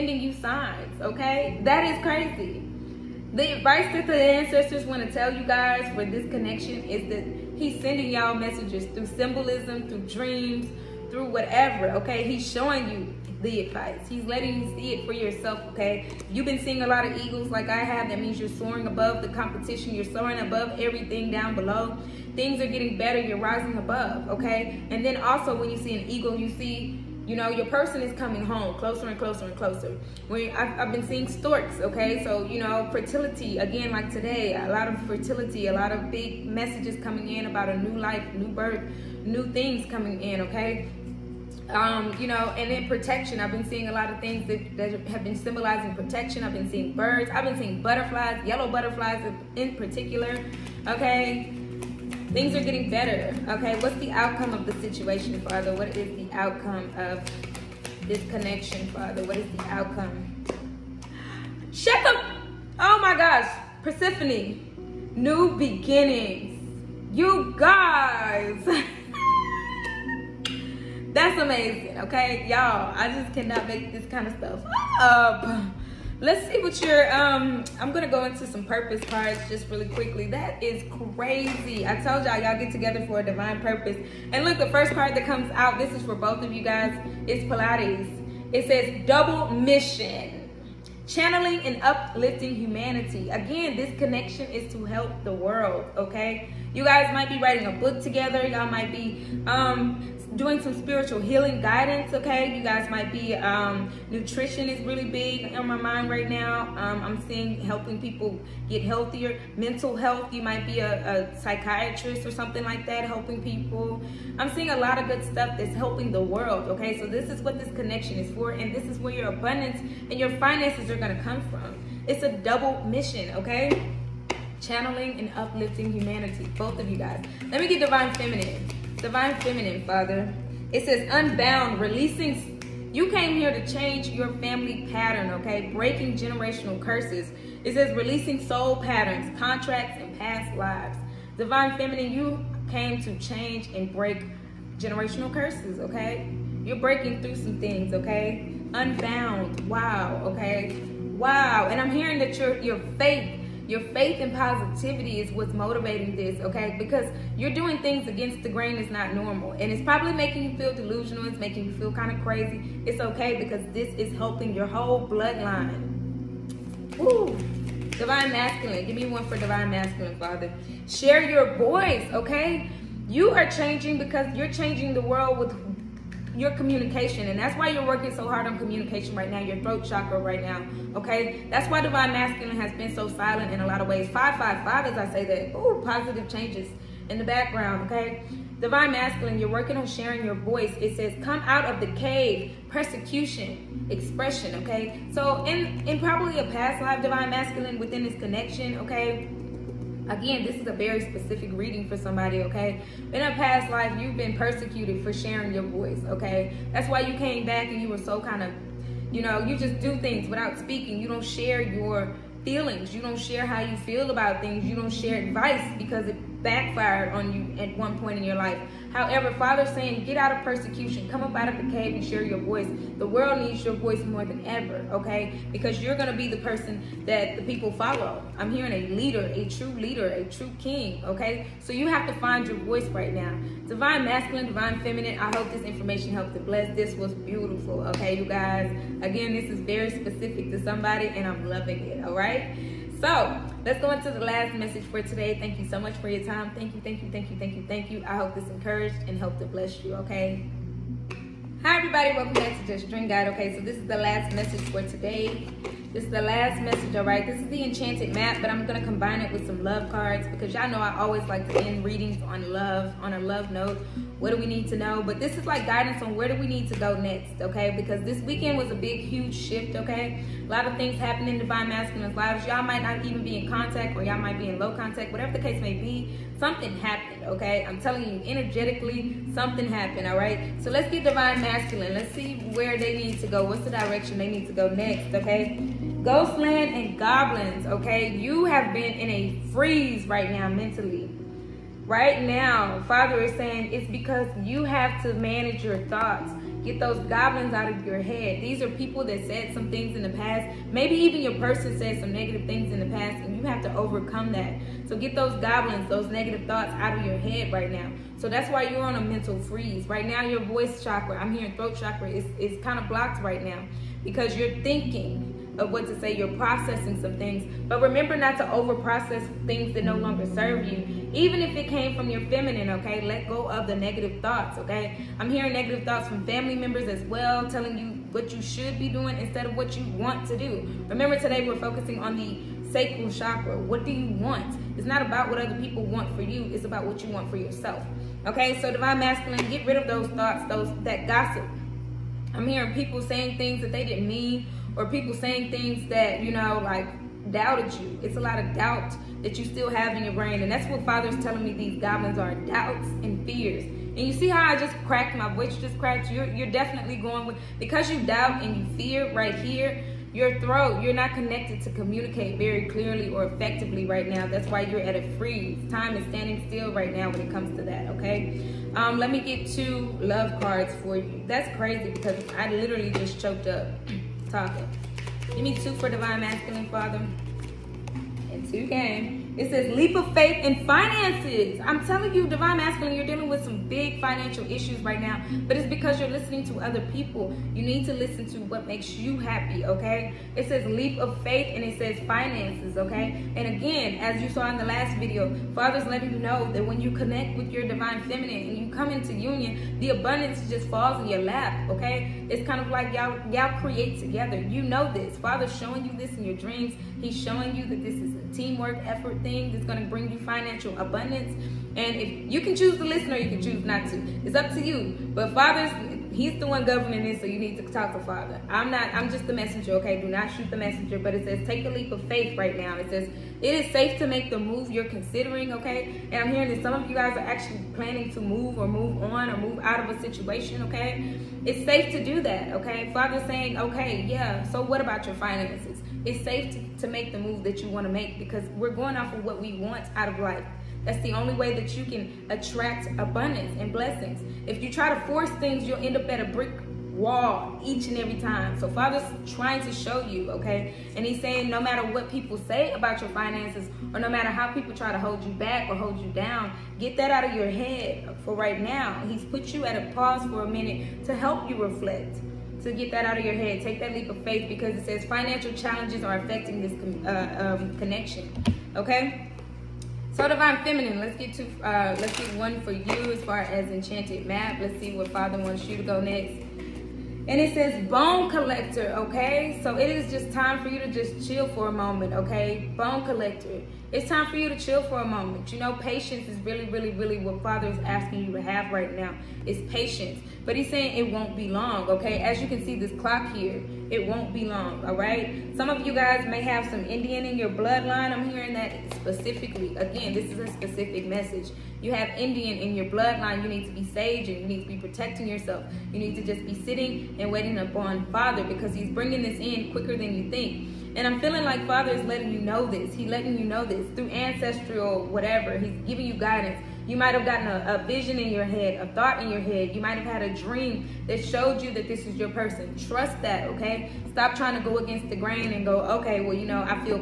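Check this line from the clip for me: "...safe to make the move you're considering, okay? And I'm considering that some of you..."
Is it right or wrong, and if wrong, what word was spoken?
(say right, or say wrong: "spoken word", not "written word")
wrong: "hearing", not "considering".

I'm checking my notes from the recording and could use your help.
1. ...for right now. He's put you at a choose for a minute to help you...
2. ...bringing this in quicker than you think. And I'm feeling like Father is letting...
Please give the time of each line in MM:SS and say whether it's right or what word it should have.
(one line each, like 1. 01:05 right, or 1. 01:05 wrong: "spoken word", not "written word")
1. 07:38 wrong: "pause", not "choose"
2. 08:28 right.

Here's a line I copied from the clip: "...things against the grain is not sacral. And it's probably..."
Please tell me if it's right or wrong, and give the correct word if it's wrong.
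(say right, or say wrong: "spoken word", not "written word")
wrong: "normal", not "sacral".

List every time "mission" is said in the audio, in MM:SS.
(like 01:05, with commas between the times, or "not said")
01:29, 02:02.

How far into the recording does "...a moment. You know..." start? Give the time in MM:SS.
08:05.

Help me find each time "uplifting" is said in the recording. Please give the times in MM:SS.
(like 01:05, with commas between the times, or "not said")
01:31, 02:05.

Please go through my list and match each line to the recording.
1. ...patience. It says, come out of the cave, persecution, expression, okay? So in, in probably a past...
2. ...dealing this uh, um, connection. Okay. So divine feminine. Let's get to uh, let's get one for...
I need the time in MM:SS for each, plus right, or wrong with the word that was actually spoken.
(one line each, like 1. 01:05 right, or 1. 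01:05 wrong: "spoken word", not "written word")
1. 03:10 wrong: "voice", not "patience"
2. 07:46 wrong: "affecting", not "dealing".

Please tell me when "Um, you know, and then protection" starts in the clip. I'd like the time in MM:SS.
00:41.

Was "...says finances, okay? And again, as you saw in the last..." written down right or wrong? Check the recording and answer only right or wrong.
right.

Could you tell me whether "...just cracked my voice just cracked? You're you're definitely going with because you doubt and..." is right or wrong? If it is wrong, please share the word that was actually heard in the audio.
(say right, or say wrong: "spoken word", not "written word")
right.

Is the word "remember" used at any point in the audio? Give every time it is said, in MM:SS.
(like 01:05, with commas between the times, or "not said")
05:17, 05:30.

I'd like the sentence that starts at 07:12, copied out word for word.
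Father's saying, okay, yeah, so what about your finances?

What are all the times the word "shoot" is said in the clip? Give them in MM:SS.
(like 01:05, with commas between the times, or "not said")
07:00.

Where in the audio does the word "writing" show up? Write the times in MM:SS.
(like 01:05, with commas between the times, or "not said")
01:37.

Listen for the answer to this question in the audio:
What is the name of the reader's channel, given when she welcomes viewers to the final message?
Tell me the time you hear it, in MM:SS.
04:12.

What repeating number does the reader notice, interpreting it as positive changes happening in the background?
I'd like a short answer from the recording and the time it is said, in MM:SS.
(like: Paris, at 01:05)
555, at 03:04.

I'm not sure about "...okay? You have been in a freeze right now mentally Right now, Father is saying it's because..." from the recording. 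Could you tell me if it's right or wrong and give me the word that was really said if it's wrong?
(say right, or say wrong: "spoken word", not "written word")
right.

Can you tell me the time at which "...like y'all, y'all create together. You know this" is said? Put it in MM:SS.
06:42.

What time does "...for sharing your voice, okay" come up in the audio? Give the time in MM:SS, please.
03:25.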